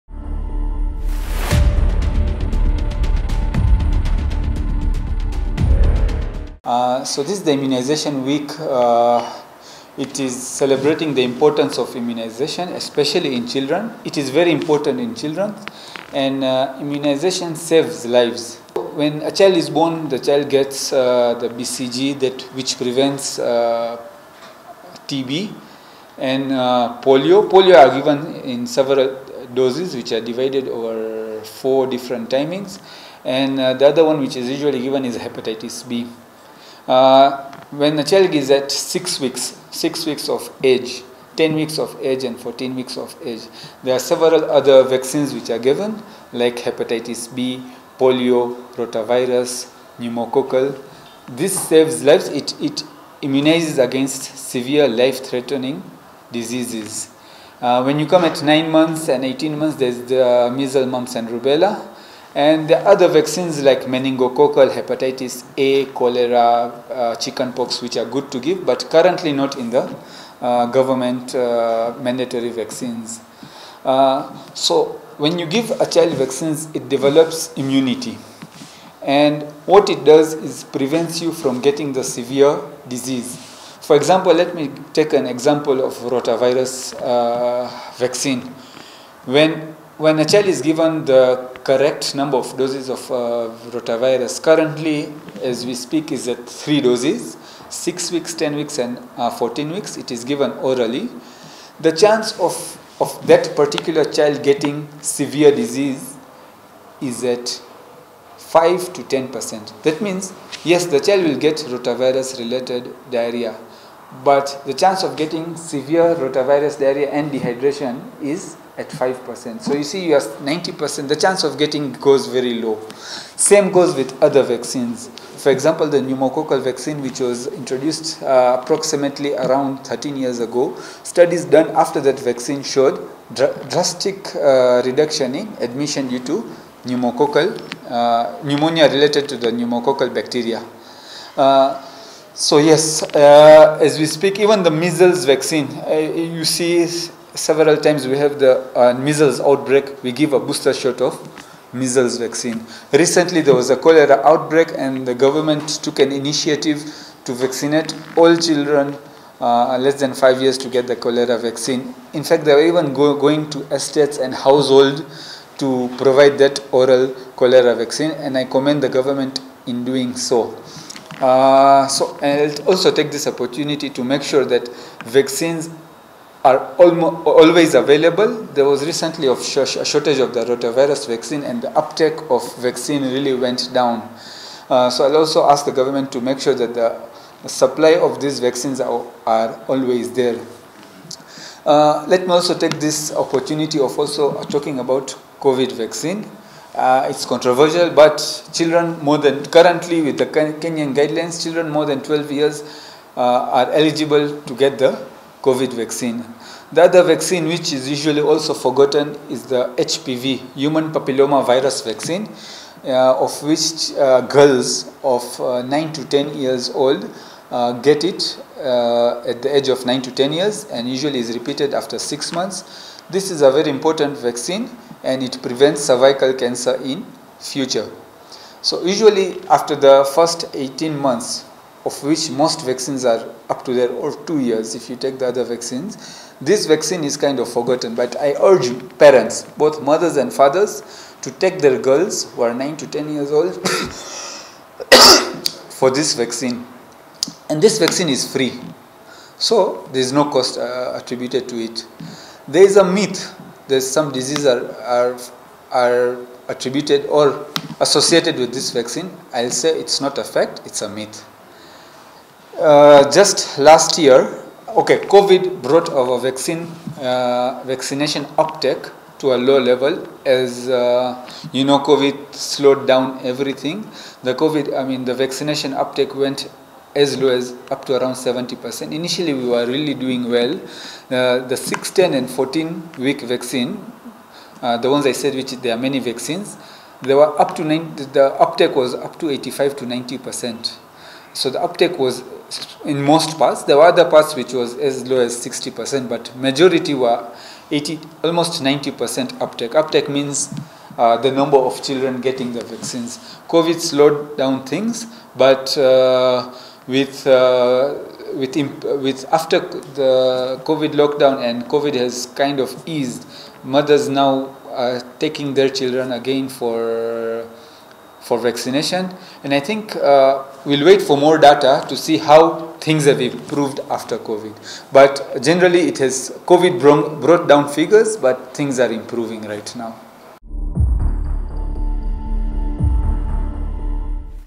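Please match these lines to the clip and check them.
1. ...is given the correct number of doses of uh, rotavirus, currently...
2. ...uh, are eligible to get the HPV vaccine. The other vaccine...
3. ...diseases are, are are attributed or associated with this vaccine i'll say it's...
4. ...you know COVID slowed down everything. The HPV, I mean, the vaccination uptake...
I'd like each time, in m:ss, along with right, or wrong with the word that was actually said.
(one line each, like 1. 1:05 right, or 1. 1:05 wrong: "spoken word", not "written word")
1. 1:30 right
2. 3:23 wrong: "COVID", not "HPV"
3. 4:14 right
4. 4:31 wrong: "COVID", not "HPV".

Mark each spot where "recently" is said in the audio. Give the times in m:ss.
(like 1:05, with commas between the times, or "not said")
2:32, 2:58.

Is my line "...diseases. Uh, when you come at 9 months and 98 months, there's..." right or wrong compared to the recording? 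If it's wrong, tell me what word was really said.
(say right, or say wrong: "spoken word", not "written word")
wrong: "18", not "98".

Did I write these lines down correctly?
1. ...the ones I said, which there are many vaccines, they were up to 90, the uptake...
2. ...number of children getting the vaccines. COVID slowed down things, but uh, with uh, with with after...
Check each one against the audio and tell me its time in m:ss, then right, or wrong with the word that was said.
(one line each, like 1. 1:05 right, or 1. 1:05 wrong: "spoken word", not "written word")
1. 4:44 right
2. 5:01 right.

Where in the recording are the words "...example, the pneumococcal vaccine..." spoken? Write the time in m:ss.
2:05.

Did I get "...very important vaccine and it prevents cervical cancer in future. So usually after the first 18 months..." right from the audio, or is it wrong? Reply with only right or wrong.
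right.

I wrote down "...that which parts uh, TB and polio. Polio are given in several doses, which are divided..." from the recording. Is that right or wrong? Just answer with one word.
wrong.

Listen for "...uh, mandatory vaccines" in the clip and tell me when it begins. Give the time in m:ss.
1:11.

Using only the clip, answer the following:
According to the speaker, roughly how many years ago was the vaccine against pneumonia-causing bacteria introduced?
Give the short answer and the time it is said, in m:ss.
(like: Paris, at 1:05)
13 years, at 2:09.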